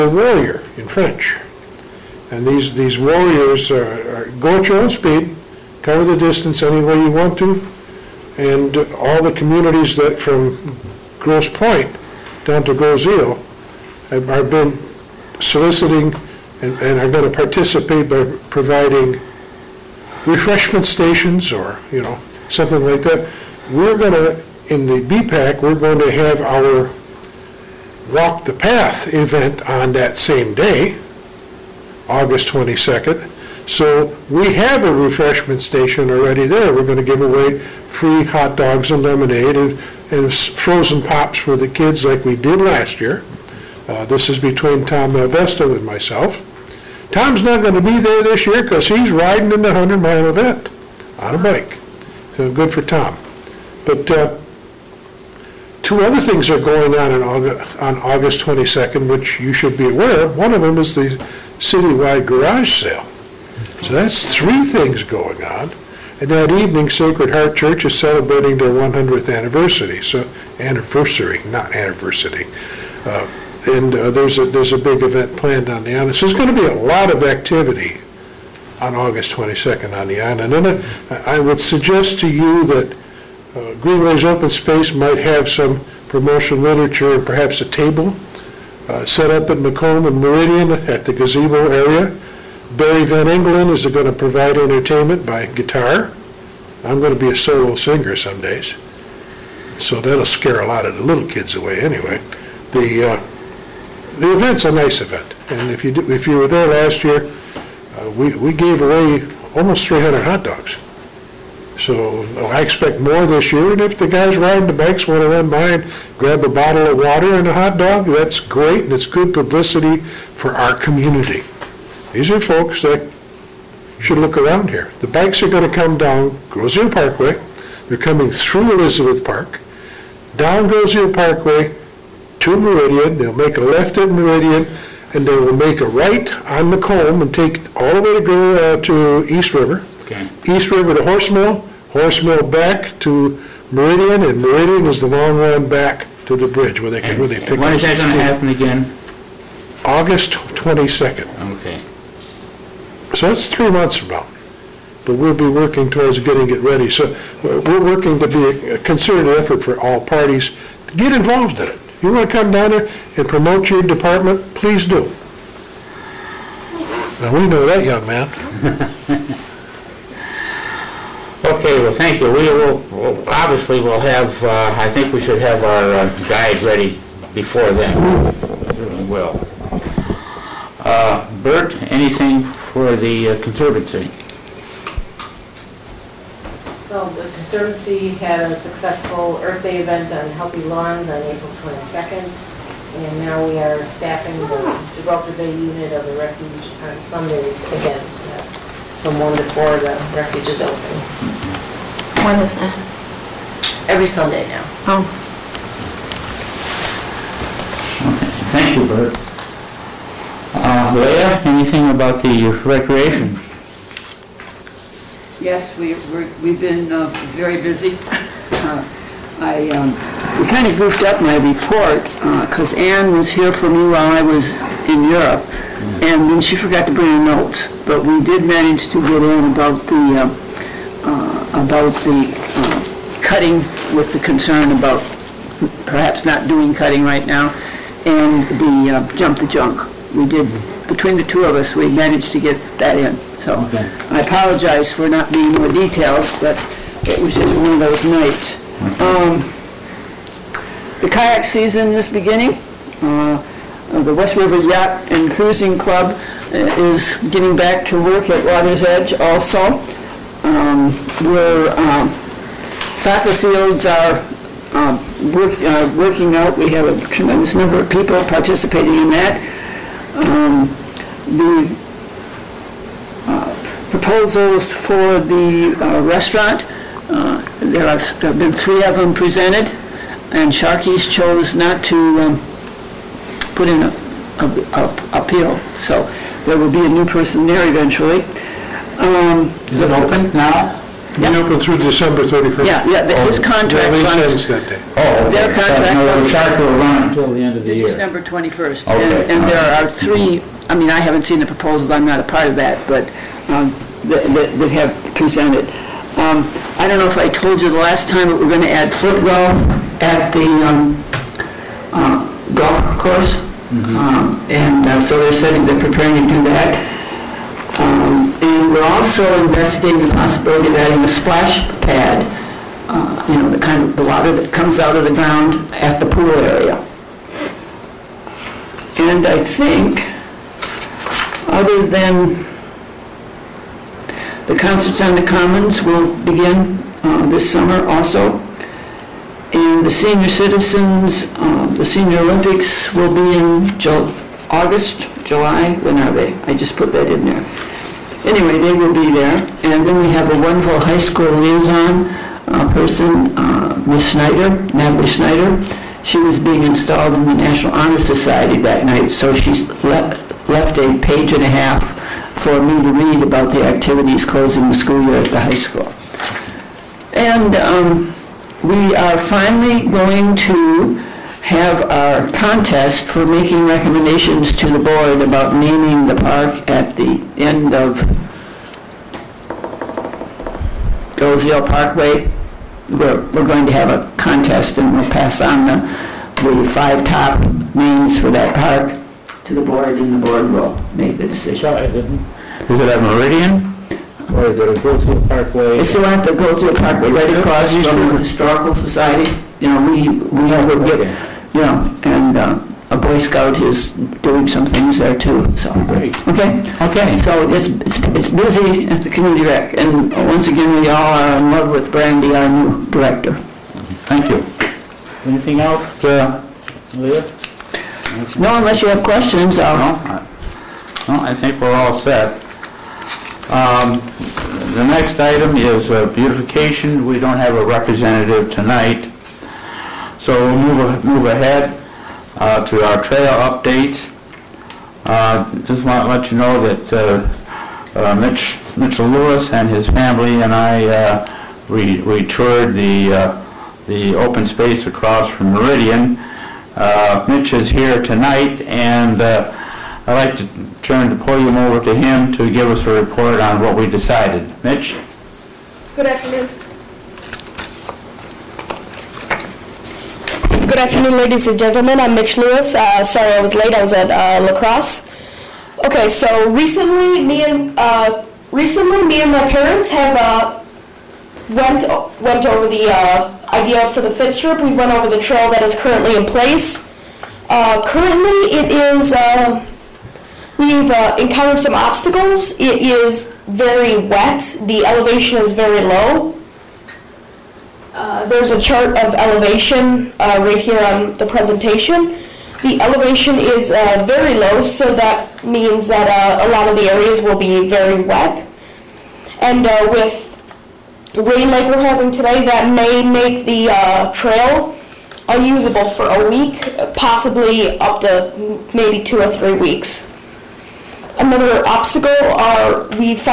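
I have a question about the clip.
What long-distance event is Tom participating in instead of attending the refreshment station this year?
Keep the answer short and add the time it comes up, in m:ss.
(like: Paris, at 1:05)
100 mile bike ride, at 0:49.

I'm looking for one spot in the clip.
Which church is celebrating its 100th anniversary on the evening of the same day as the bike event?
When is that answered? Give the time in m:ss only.
1:06.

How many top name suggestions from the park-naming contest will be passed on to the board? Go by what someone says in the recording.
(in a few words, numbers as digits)
5.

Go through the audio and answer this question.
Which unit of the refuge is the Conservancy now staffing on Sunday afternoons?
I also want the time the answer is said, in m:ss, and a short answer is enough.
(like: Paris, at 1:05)
Gibraltar Bay, at 3:14.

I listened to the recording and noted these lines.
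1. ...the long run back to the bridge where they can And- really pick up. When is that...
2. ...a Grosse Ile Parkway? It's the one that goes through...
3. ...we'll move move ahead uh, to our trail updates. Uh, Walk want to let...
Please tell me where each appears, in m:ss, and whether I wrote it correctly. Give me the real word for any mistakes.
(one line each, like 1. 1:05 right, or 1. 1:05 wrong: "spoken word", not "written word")
1. 2:24 right
2. 6:34 right
3. 7:10 wrong: "Just", not "Walk".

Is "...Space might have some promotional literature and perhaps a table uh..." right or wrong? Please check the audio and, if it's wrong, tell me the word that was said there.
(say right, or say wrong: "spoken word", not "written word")
right.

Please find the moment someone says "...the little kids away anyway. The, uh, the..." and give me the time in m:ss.
1:40.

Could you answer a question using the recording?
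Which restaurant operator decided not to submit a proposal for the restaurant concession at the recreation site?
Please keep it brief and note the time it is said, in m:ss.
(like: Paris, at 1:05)
Sharkies, at 4:40.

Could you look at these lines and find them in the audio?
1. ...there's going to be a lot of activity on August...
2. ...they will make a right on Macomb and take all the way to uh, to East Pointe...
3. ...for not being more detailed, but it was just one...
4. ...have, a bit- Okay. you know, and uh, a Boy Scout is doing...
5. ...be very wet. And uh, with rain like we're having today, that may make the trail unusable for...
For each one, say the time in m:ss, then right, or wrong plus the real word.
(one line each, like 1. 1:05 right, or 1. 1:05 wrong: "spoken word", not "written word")
1. 1:16 right
2. 2:15 wrong: "River", not "Pointe"
3. 4:04 right
4. 6:40 right
5. 8:17 right.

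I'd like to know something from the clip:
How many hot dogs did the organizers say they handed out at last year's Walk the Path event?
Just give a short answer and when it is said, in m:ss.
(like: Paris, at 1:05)
300, at 1:49.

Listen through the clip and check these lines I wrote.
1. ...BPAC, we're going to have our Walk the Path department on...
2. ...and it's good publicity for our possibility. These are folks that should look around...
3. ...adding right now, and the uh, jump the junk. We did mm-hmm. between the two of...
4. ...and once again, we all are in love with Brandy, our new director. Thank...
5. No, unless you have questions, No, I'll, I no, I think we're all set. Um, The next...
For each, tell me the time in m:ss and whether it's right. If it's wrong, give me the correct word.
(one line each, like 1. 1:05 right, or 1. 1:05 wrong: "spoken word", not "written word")
1. 0:25 wrong: "event", not "department"
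2. 1:58 wrong: "community", not "possibility"
3. 3:56 wrong: "cutting", not "adding"
4. 6:49 right
5. 6:58 right.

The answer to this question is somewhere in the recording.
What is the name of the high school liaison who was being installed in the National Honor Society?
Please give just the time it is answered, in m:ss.
5:54.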